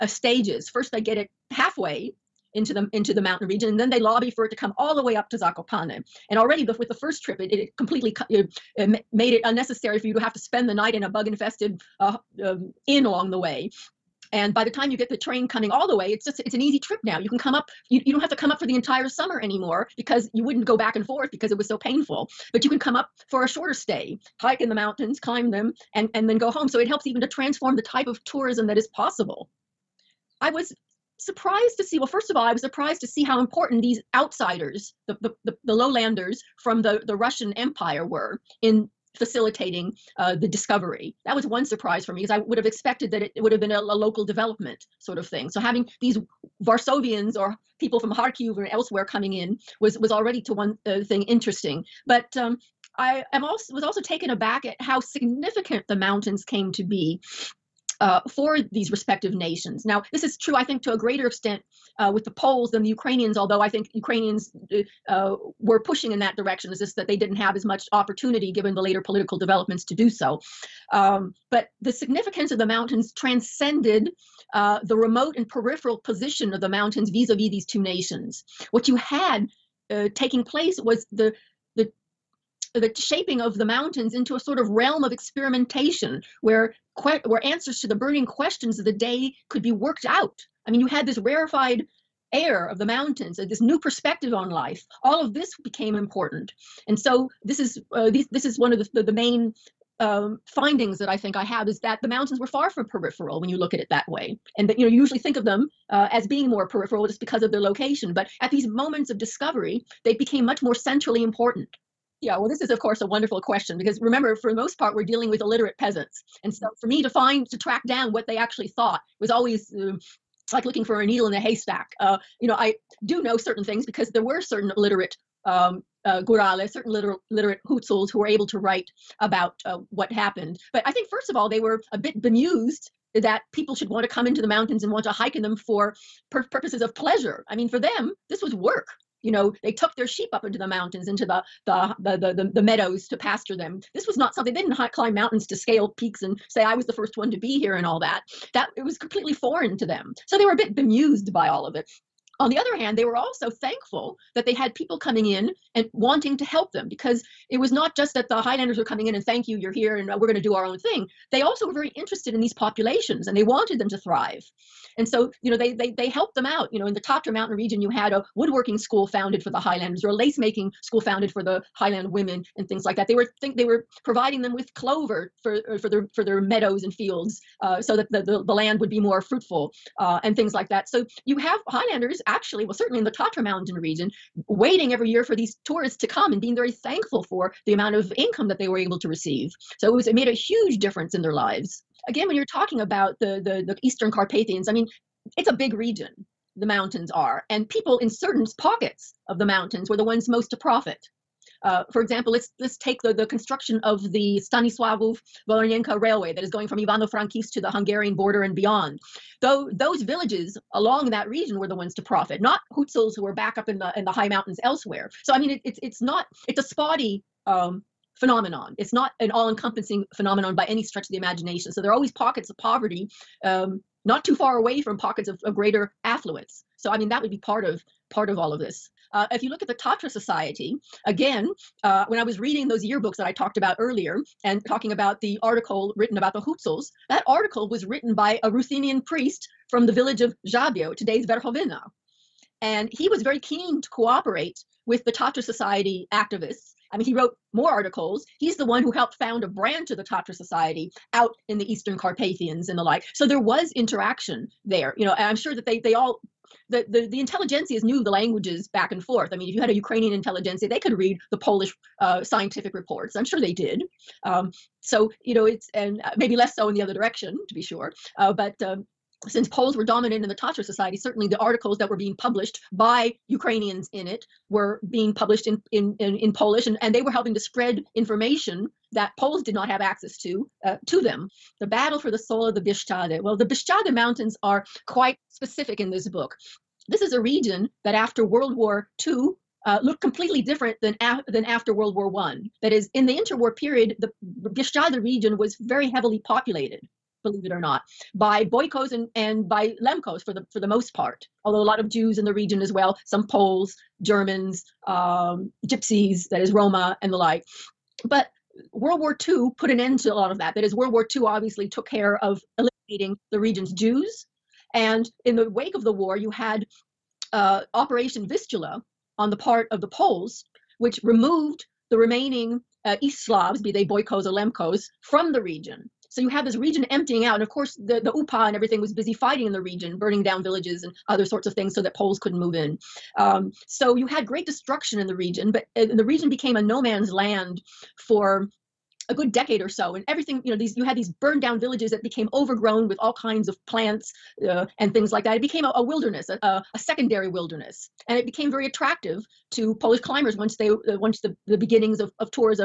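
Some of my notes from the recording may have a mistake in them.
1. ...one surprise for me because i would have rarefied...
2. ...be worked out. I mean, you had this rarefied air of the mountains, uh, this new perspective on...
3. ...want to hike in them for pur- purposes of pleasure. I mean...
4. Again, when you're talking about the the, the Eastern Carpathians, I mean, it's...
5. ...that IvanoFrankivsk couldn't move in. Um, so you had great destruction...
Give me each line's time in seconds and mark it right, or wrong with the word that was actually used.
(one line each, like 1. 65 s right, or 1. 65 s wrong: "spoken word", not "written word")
1. 41 s wrong: "expected", not "rarefied"
2. 89 s right
3. 134 s right
4. 192 s right
5. 331 s wrong: "Poles", not "IvanoFrankivsk".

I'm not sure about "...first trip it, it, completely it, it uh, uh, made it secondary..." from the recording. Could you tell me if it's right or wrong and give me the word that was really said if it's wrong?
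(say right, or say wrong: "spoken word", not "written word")
wrong: "unnecessary", not "secondary".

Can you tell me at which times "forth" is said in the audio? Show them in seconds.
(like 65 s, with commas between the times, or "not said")
21 s, 259 s.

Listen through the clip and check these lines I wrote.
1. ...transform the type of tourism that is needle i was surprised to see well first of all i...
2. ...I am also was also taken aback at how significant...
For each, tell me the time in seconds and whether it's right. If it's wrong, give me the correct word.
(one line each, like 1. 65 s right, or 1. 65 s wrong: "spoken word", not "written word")
1. 27 s wrong: "possible", not "needle"
2. 52 s right.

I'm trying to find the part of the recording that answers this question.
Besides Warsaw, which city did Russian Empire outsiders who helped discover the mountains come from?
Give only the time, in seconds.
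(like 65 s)
48 s.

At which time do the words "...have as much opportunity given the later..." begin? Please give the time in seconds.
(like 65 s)
67 s.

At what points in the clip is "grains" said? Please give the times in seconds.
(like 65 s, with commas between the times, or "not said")
not said.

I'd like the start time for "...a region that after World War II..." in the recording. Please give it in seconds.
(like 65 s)
287 s.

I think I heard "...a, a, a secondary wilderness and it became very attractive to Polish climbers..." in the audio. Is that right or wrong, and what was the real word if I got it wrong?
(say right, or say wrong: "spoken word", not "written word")
right.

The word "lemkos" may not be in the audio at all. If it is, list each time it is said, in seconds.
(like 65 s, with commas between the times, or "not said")
299 s, 324 s.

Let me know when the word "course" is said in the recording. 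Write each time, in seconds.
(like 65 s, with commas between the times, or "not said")
112 s, 327 s.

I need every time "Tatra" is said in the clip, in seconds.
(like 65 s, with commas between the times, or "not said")
166 s, 183 s, 229 s, 245 s, 250 s, 270 s.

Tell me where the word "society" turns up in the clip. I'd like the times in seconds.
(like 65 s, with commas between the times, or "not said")
230 s, 245 s, 250 s, 270 s.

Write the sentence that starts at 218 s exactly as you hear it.
It's not an all-encompassing phenomenon by any stretch of the imagination.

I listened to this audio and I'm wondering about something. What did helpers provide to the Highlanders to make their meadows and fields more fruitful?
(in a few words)
Clover.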